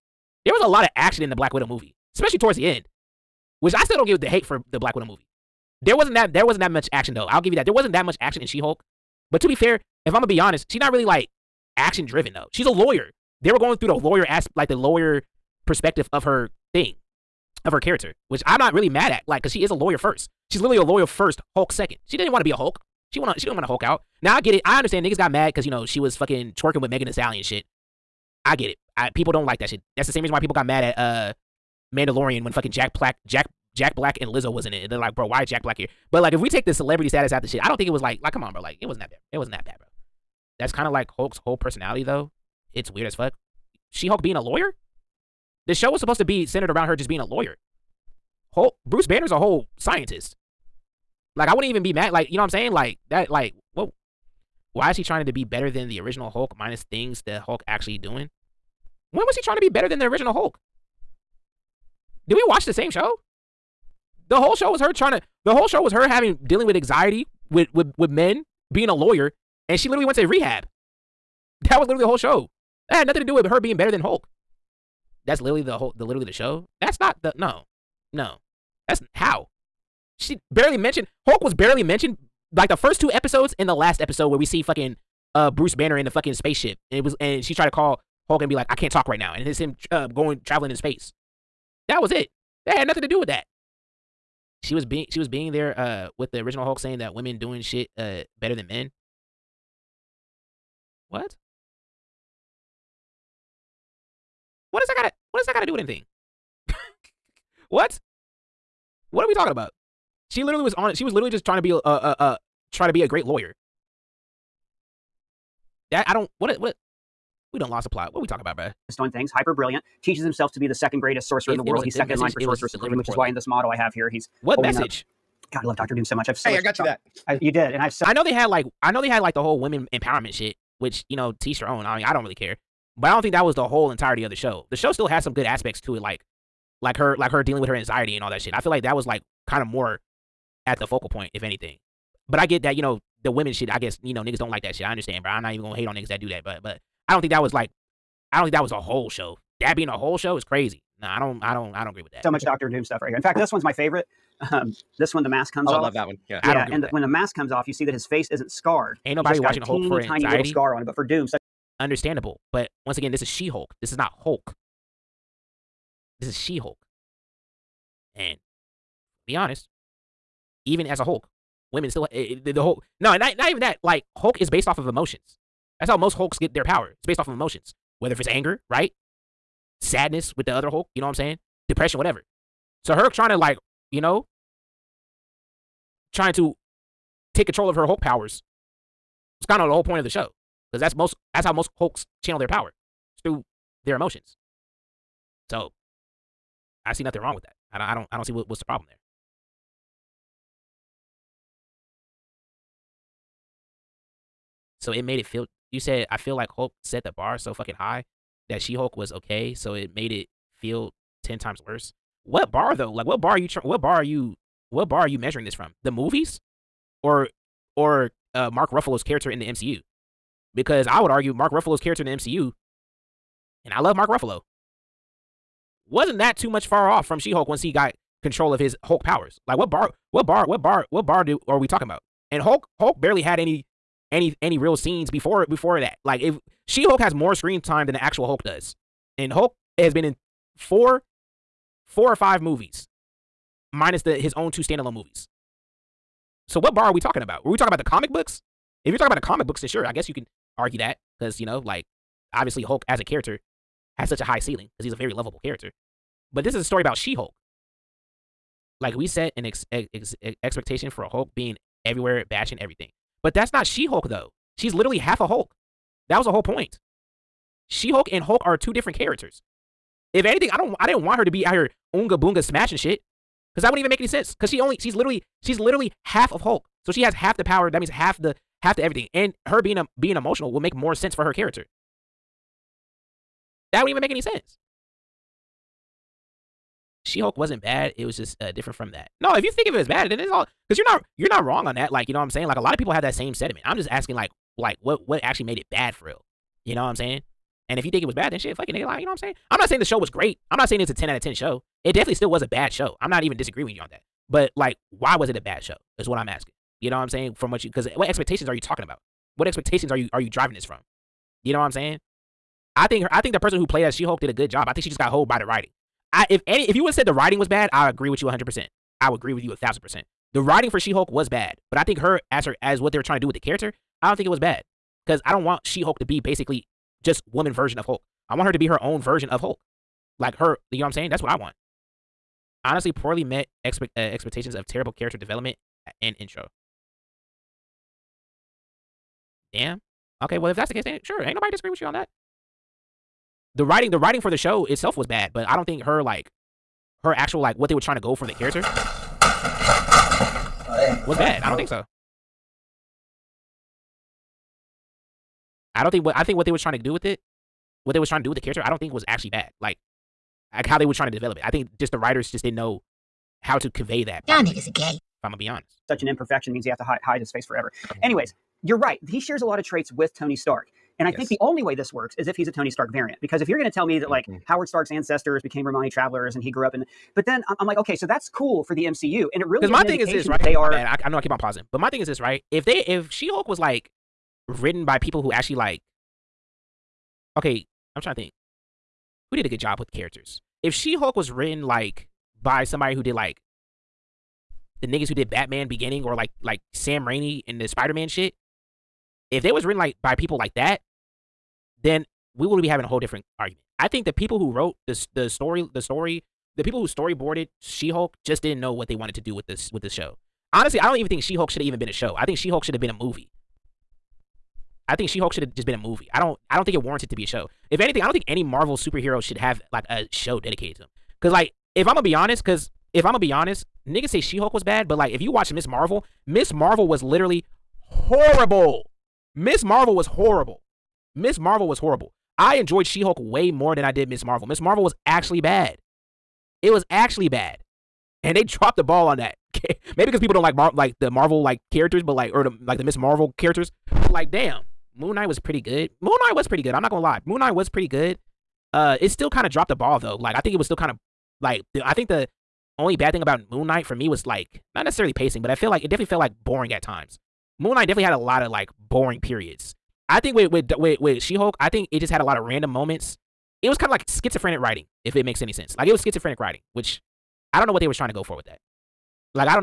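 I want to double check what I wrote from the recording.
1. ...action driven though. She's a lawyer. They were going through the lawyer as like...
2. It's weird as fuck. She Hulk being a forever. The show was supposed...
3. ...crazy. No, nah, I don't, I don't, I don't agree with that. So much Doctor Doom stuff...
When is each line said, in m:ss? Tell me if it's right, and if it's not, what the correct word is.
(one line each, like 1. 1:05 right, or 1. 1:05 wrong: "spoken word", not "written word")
1. 0:11 right
2. 0:42 wrong: "lawyer", not "forever"
3. 2:30 right.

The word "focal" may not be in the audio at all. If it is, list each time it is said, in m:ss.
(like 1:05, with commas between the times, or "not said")
2:20.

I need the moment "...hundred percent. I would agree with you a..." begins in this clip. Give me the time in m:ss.
5:18.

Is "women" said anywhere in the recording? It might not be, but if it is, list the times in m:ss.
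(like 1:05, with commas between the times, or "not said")
1:37, 2:09, 2:23, 2:51.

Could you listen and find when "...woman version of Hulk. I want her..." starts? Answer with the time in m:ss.
5:27.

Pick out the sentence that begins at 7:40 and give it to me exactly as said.
I think with with with with She Hulk, I think it just had a lot of random moments.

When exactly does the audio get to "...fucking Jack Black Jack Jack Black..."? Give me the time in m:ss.
0:32.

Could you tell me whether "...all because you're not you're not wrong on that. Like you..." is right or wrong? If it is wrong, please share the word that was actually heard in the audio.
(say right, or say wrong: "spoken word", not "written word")
right.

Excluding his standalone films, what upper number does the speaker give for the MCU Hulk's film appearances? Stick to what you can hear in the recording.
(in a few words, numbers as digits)
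5.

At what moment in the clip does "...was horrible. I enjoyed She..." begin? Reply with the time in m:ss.
7:11.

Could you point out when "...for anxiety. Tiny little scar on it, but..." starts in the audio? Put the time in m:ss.
2:39.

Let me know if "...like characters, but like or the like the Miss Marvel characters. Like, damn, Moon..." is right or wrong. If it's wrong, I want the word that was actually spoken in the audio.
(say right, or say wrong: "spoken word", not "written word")
right.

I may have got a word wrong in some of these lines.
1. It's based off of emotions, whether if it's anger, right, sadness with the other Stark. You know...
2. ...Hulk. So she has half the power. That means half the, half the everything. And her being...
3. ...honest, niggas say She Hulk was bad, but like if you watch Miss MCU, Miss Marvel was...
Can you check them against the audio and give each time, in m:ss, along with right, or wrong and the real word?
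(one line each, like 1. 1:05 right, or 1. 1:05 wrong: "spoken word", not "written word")
1. 2:56 wrong: "Hulk", not "Stark"
2. 4:36 right
3. 7:03 wrong: "Marvel", not "MCU".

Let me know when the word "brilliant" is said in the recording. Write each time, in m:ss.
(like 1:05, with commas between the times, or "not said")
1:59.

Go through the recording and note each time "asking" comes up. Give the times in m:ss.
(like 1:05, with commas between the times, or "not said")
4:53, 5:06.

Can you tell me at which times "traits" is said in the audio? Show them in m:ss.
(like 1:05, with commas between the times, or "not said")
6:09.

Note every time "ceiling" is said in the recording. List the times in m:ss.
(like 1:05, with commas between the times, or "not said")
4:14.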